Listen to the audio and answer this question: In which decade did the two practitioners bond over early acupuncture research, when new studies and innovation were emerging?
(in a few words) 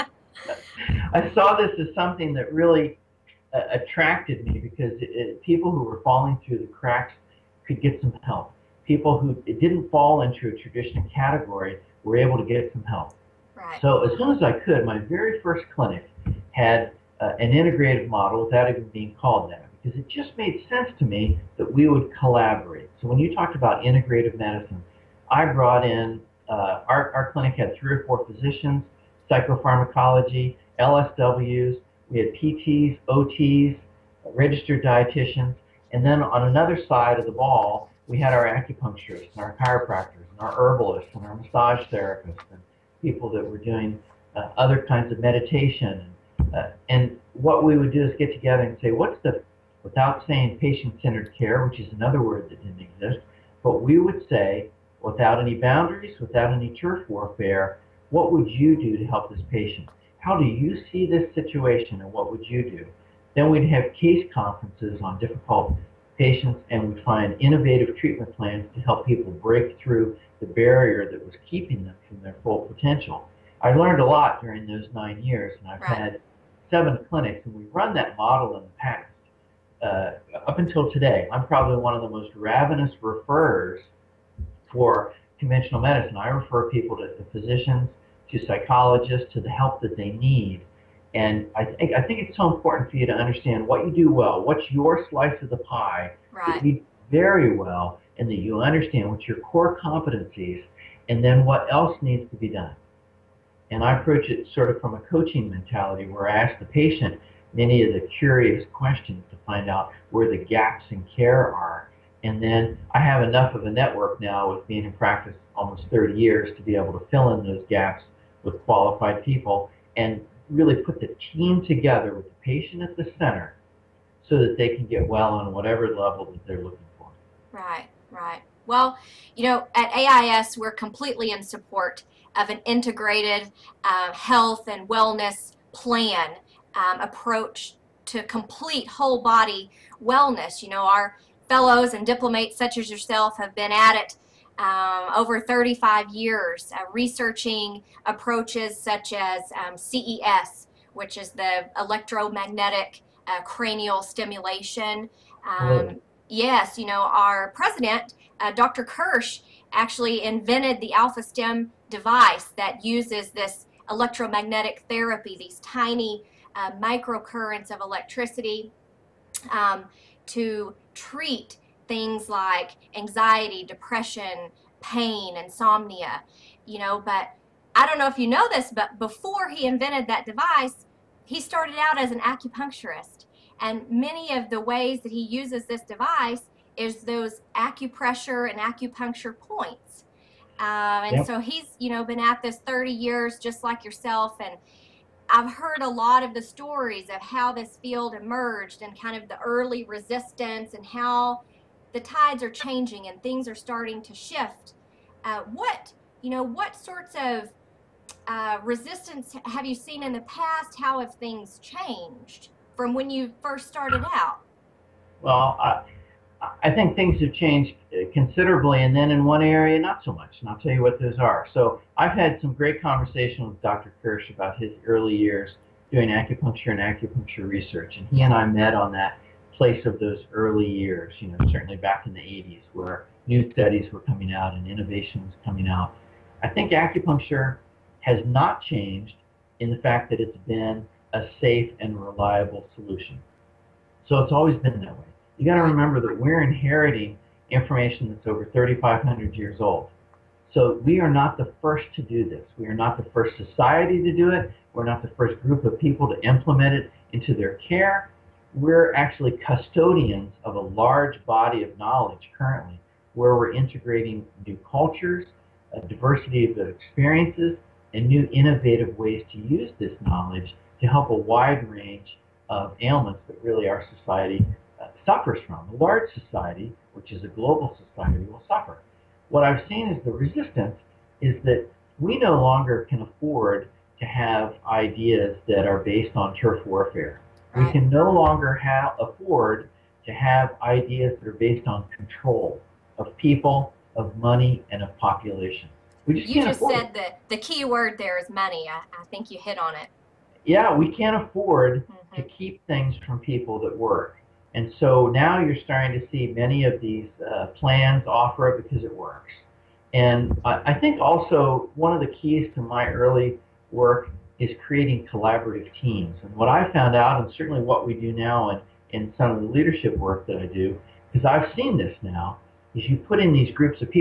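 1980s.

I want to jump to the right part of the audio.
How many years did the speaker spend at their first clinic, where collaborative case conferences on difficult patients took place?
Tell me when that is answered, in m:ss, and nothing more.
1:14.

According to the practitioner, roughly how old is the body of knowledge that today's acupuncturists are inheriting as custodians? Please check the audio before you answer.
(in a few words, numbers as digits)
3,500 years.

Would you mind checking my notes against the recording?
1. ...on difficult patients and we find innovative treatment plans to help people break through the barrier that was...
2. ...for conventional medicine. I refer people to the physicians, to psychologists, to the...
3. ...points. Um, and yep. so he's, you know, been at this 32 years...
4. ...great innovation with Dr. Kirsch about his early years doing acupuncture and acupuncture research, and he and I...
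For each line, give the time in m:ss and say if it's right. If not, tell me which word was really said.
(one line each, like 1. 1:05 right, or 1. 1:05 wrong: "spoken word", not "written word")
1. 1:05 right
2. 1:24 right
3. 3:09 wrong: "30", not "32"
4. 3:42 wrong: "conversation", not "innovation".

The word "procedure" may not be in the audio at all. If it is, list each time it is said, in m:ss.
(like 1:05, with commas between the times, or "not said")
not said.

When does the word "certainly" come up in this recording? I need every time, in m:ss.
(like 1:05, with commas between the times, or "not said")
3:51, 5:17.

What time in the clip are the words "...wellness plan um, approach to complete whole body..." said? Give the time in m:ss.
2:14.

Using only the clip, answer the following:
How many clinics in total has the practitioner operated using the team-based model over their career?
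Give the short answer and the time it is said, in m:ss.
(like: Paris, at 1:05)
7, at 1:16.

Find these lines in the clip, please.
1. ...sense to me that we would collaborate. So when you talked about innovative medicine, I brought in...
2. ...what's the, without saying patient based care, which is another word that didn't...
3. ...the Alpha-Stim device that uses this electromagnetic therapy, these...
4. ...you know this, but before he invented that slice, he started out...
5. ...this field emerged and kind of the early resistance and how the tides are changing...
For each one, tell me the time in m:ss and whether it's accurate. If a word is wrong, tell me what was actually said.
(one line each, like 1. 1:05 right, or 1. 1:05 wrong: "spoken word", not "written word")
1. 0:20 wrong: "integrative", not "innovative"
2. 0:48 wrong: "centered", not "based"
3. 2:40 right
4. 2:58 wrong: "device", not "slice"
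5. 3:17 right.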